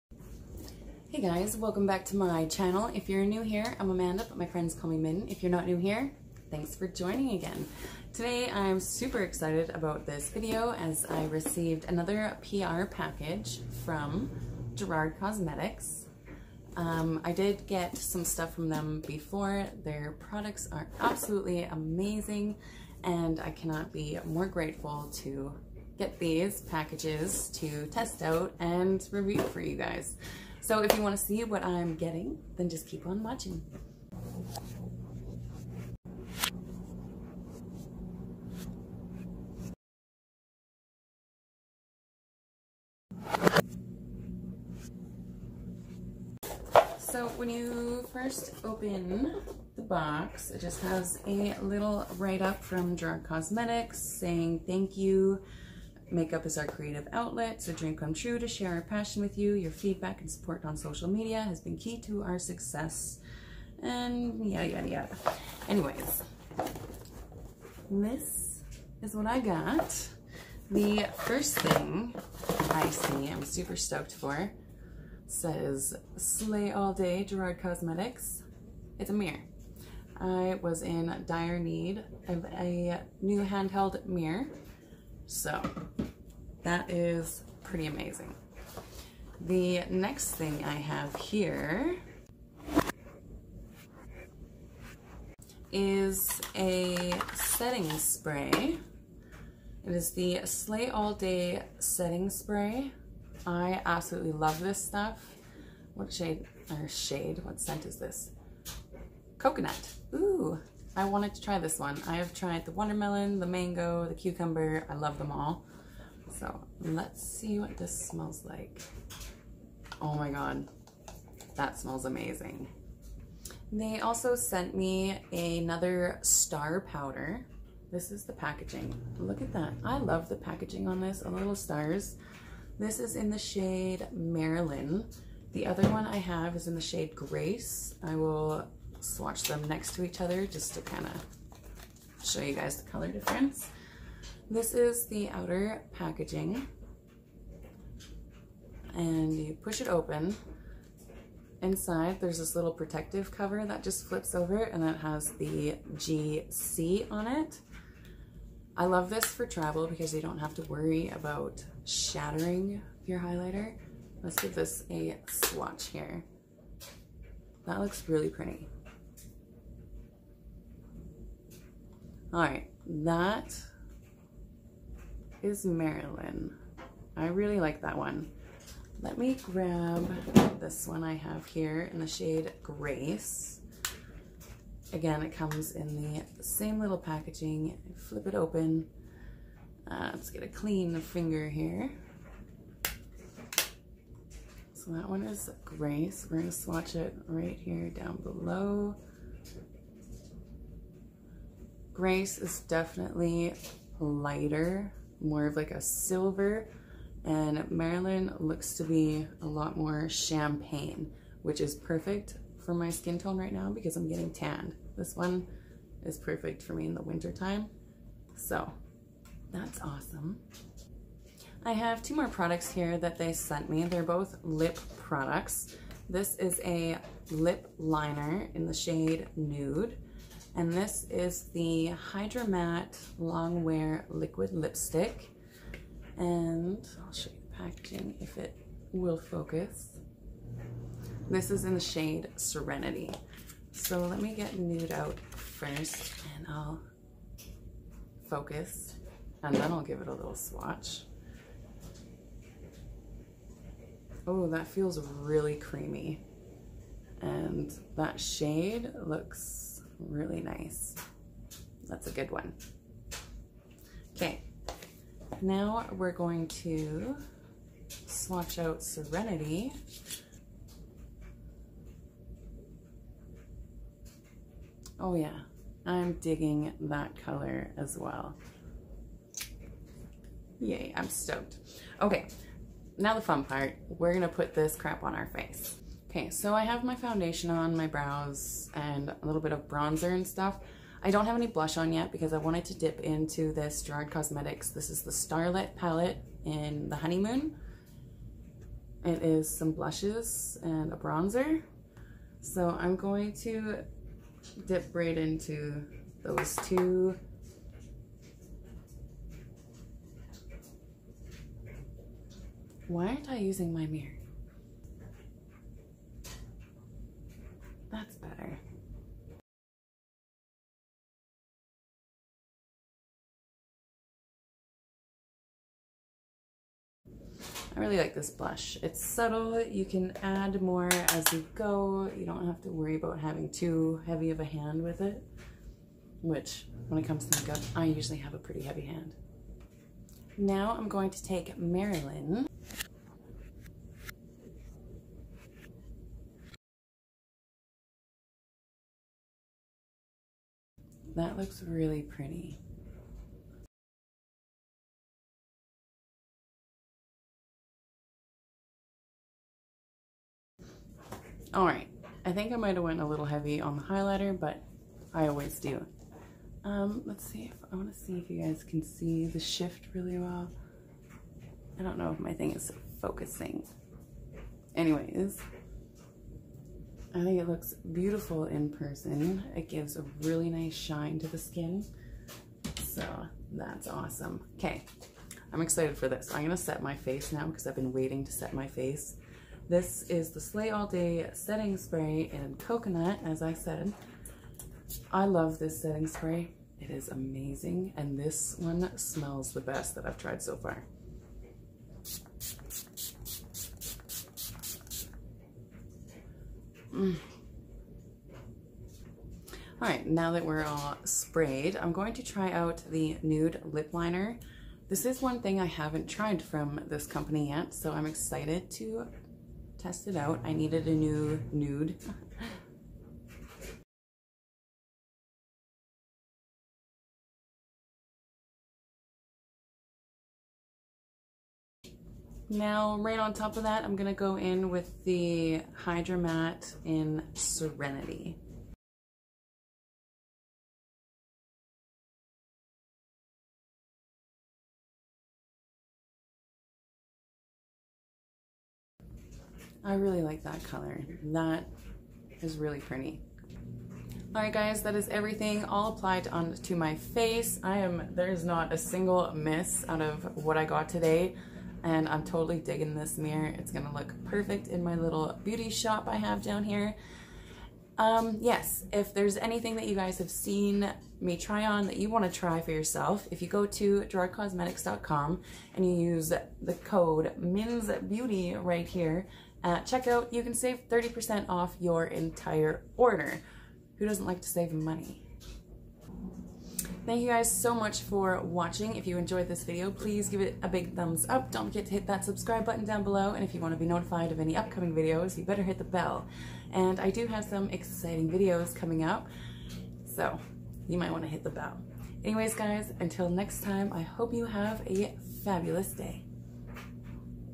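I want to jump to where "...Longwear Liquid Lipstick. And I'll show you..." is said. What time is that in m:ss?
3:53.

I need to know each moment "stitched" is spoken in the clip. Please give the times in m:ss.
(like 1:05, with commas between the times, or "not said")
not said.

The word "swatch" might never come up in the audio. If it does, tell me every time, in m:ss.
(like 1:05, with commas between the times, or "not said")
2:18, 2:45, 3:16, 4:10, 4:28.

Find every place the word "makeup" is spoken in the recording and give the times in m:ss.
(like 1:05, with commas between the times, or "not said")
0:56, 5:37.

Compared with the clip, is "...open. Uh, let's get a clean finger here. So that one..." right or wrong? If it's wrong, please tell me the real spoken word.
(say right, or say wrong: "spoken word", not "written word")
right.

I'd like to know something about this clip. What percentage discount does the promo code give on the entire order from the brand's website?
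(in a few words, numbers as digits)
30%.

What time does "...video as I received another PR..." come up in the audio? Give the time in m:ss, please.
0:10.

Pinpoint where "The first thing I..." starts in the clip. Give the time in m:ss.
1:10.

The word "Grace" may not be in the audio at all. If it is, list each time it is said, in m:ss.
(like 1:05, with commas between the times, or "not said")
2:17, 3:02, 3:15, 3:21.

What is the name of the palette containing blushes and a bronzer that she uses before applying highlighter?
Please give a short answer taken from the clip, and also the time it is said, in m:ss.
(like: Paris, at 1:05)
Starlit, at 4:55.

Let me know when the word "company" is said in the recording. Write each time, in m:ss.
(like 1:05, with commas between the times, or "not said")
6:57.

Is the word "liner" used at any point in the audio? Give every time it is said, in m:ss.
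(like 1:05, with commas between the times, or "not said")
3:47, 6:53.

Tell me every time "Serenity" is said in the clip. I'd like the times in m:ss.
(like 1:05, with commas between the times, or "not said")
4:02, 4:28, 7:17.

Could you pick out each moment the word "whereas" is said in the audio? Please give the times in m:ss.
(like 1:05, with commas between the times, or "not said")
not said.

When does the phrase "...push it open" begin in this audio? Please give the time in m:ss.
2:29.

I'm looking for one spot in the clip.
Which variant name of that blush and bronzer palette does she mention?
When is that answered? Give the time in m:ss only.
4:56.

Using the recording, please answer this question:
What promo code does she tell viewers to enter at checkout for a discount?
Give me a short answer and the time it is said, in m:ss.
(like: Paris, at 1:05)
Min's Beauty, at 7:57.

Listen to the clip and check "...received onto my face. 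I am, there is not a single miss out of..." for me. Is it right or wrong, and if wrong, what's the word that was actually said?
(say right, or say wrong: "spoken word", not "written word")
wrong: "applied", not "received".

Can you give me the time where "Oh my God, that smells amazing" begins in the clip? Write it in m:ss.
2:00.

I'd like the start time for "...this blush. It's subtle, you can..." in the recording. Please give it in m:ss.
5:28.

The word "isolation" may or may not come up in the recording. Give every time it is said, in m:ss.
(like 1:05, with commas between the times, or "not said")
not said.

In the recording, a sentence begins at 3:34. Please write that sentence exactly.
This one is perfect for me in the winter time.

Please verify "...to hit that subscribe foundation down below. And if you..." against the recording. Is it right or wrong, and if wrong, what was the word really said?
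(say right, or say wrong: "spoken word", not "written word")
wrong: "button", not "foundation".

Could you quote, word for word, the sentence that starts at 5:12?
Why aren't I using my mirror?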